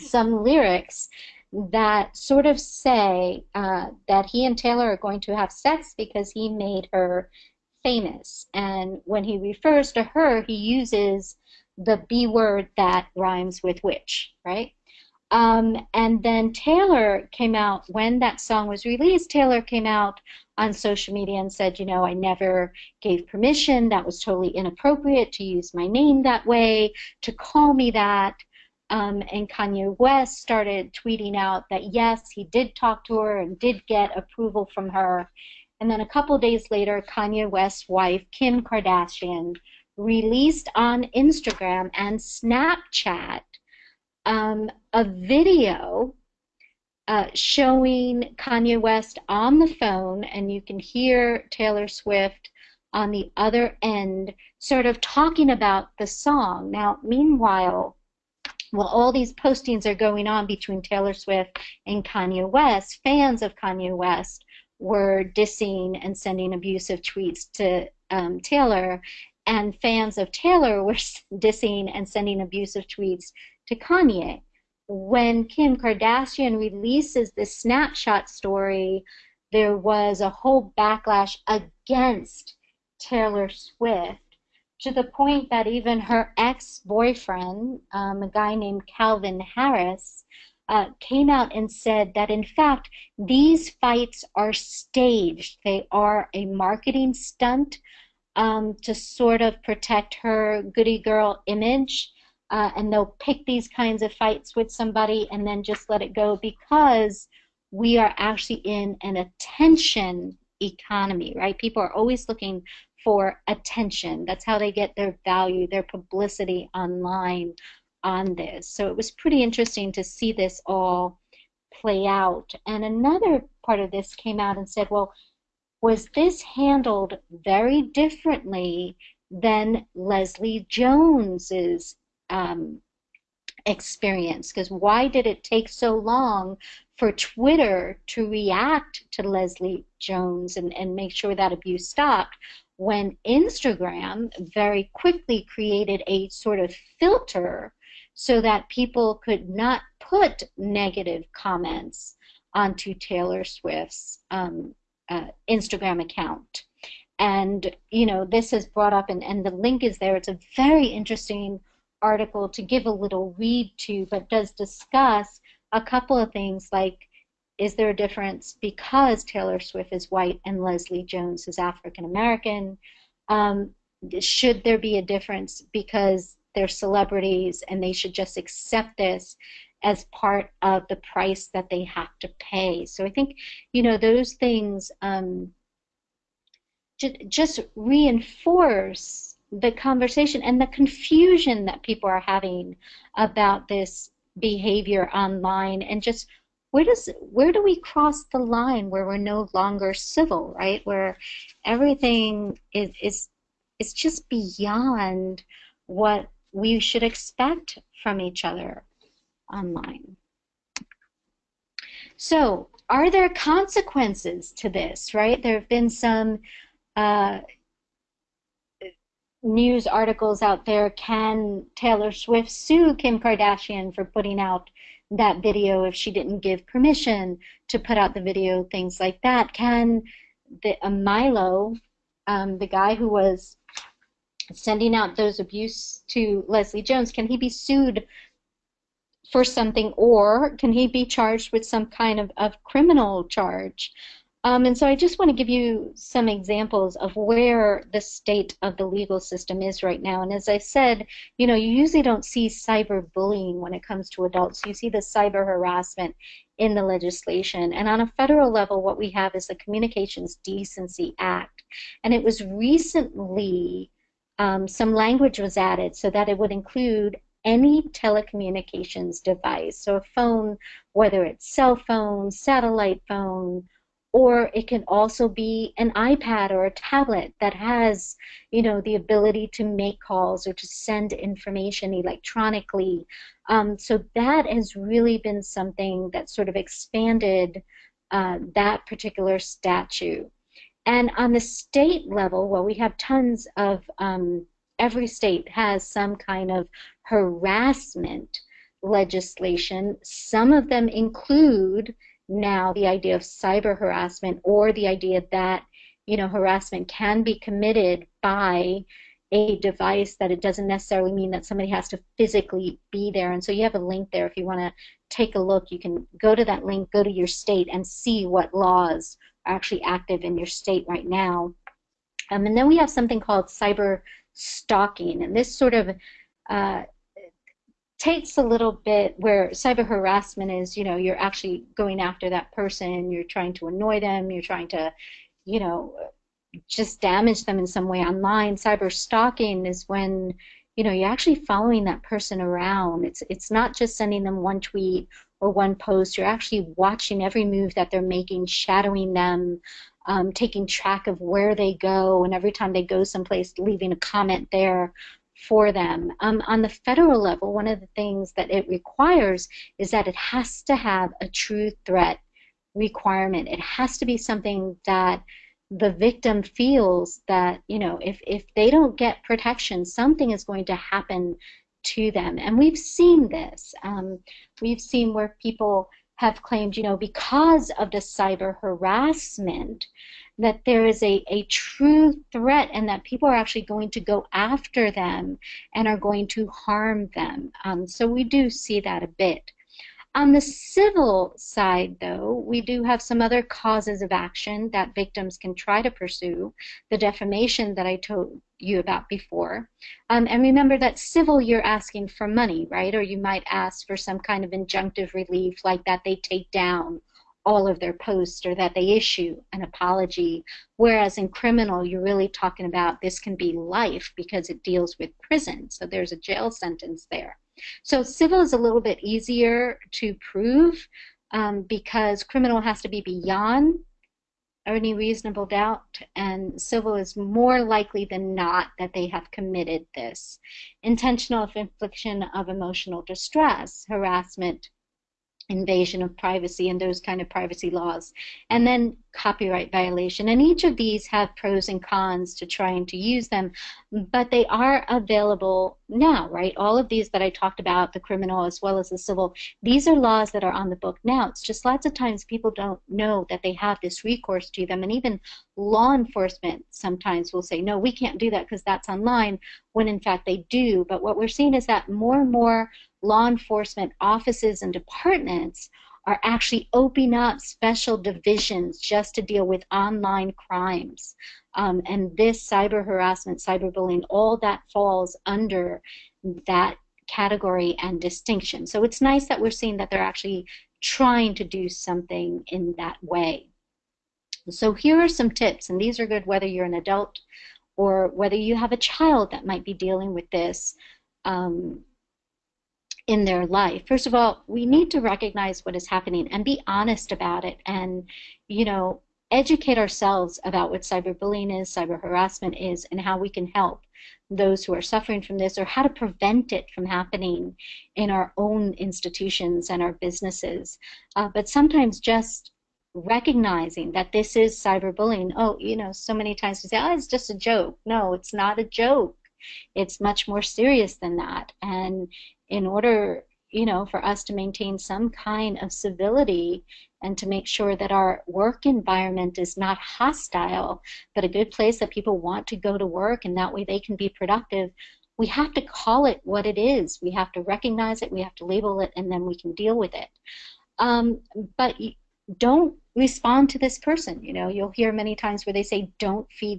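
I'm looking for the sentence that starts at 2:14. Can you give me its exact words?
Because why did it take so long for Twitter to react to Leslie Jones and, and make sure that abuse stopped?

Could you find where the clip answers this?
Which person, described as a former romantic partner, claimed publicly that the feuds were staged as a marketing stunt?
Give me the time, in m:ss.
1:28.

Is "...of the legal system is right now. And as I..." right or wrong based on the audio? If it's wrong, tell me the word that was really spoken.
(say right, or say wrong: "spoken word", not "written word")
right.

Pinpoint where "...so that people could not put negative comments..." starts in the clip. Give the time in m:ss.
2:28.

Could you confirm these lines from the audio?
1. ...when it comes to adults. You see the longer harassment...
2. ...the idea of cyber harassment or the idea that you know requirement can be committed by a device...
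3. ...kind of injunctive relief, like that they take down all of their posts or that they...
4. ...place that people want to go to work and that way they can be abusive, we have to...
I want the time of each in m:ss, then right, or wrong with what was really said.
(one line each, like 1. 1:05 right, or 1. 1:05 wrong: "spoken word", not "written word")
1. 4:13 wrong: "cyber", not "longer"
2. 5:02 wrong: "harassment", not "requirement"
3. 6:44 right
4. 8:51 wrong: "productive", not "abusive".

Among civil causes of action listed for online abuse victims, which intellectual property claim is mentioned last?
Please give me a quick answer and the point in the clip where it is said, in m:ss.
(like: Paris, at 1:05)
copyright violation, at 7:19.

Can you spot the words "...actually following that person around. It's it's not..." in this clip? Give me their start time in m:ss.
5:41.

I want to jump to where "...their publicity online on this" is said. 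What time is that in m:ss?
1:55.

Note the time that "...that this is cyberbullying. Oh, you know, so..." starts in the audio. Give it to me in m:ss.
8:33.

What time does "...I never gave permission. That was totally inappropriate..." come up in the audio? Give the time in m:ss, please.
0:22.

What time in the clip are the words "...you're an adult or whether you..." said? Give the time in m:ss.
8:06.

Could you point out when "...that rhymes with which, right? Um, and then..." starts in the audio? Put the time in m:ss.
0:12.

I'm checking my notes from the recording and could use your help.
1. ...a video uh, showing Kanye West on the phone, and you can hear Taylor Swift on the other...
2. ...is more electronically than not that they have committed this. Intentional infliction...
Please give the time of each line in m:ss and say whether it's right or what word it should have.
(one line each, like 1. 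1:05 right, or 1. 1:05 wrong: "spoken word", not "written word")
1. 0:44 right
2. 7:06 wrong: "likely", not "electronically".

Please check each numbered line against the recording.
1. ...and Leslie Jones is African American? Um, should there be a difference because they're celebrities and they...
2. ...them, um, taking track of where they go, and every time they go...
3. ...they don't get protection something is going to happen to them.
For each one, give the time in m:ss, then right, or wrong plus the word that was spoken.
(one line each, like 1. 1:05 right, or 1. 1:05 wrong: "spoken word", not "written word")
1. 2:50 right
2. 5:49 right
3. 6:08 right.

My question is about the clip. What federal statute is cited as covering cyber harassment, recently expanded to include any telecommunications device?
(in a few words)
Communications Decency Act.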